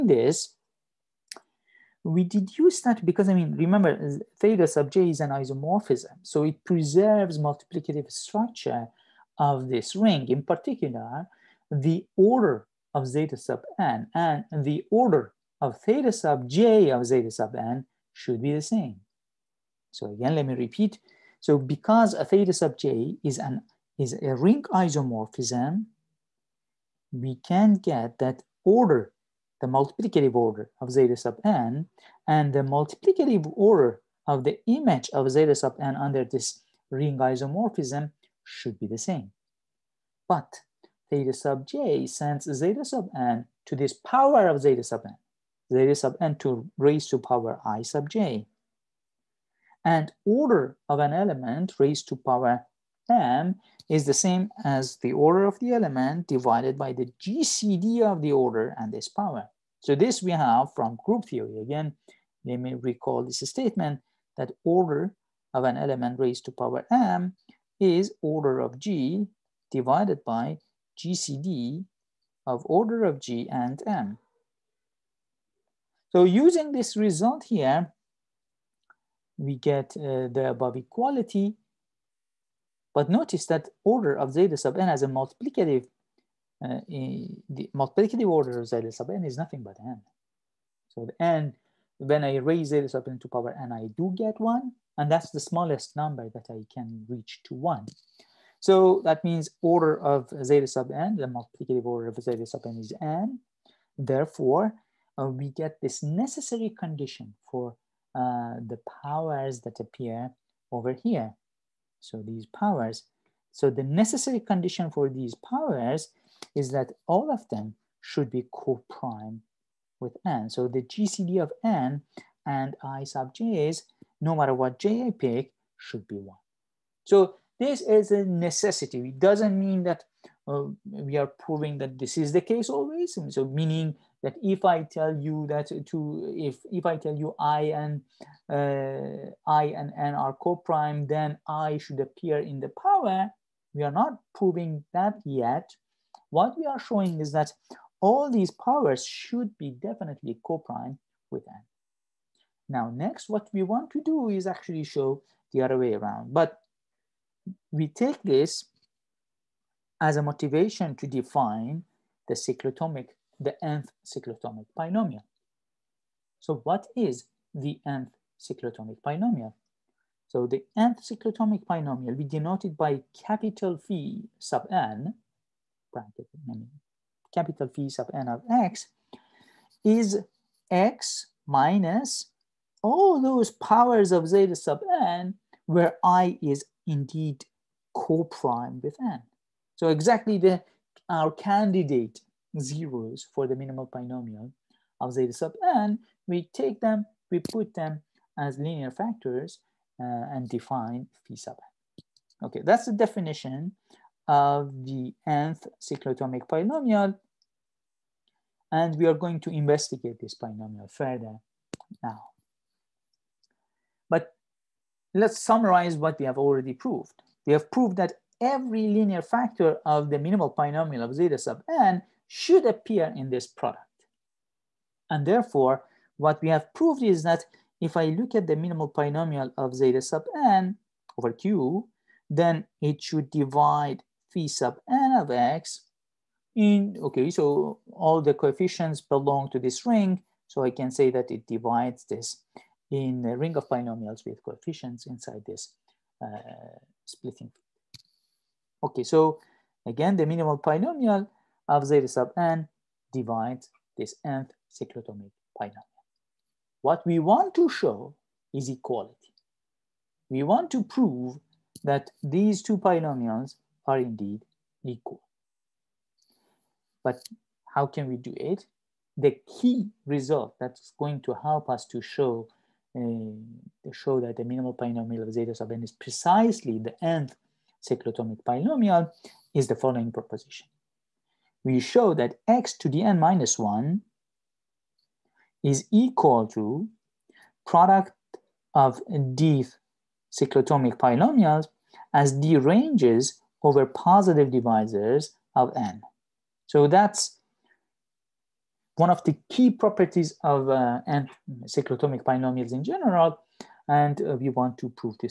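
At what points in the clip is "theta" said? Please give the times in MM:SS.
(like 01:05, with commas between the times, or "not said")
00:04, 00:15, 00:22, 00:41.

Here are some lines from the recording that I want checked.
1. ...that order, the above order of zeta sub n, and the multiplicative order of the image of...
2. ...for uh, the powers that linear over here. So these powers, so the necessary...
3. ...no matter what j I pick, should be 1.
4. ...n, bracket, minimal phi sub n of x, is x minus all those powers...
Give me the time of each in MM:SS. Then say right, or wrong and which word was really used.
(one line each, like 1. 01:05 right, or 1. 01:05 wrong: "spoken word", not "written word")
1. 00:28 wrong: "multiplicative", not "above"
2. 01:47 wrong: "appear", not "linear"
3. 02:04 right
4. 02:54 wrong: "capital", not "minimal".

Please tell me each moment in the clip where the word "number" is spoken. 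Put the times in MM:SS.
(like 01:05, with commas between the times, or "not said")
01:35.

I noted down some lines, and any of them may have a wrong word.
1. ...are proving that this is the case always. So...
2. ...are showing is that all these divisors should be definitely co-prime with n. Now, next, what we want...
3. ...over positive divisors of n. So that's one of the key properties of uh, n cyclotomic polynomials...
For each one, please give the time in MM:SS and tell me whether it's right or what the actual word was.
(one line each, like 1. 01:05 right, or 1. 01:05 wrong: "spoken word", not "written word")
1. 02:11 right
2. 02:26 wrong: "powers", not "divisors"
3. 04:53 right.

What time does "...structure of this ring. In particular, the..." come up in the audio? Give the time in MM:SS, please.
00:08.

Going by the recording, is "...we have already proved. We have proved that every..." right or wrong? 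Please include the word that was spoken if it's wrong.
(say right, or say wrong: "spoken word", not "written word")
right.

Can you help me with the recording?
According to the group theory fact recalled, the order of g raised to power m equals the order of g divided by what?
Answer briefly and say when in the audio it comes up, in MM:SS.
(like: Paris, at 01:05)
GCD of order of g and m, at 01:10.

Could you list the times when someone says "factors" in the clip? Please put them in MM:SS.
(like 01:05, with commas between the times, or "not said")
03:18, 03:39.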